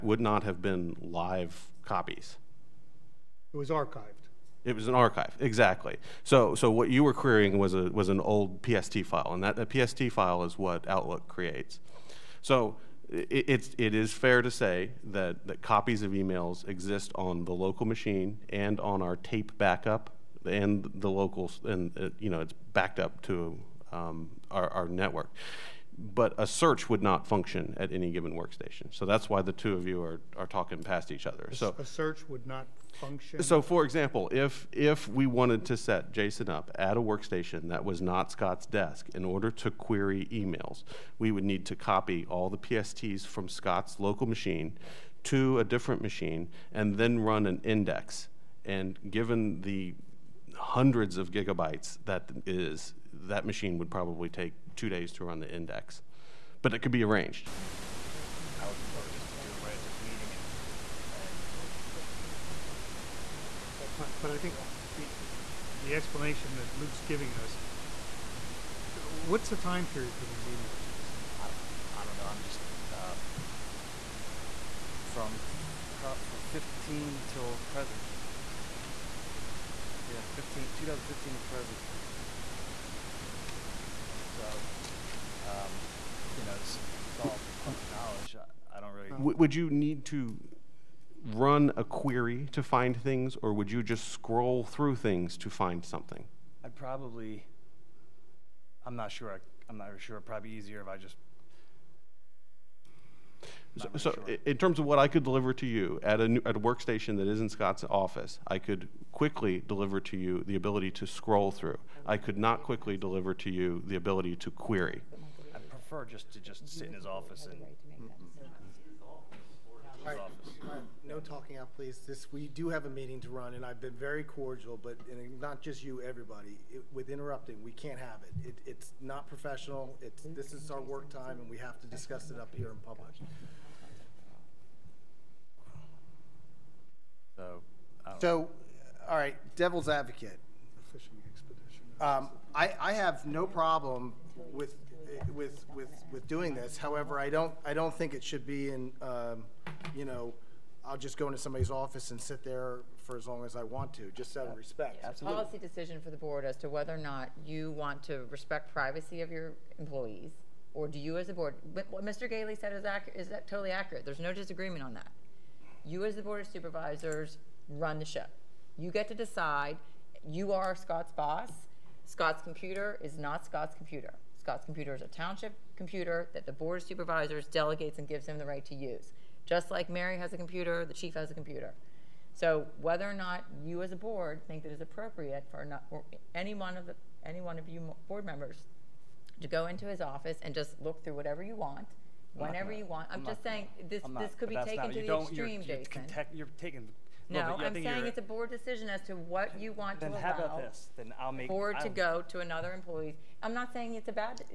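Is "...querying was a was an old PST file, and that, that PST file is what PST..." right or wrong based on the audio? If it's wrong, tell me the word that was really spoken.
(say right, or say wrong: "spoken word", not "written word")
wrong: "Outlook", not "PST".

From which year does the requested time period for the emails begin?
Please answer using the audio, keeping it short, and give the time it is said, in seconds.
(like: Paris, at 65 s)
2015, at 80 s.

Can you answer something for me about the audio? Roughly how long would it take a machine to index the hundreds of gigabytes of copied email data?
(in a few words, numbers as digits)
2 days.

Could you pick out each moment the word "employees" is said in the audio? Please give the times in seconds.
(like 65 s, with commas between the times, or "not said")
159 s, 202 s.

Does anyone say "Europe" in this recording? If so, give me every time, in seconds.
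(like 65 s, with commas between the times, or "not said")
not said.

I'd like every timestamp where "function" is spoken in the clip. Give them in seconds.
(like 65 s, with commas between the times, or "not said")
27 s, 32 s.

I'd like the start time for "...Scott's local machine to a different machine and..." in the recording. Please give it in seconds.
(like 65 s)
43 s.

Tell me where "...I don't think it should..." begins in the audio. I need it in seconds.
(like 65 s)
147 s.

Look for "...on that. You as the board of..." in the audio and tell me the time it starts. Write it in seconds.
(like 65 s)
164 s.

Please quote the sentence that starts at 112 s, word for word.
I could not quickly deliver to you the ability to query.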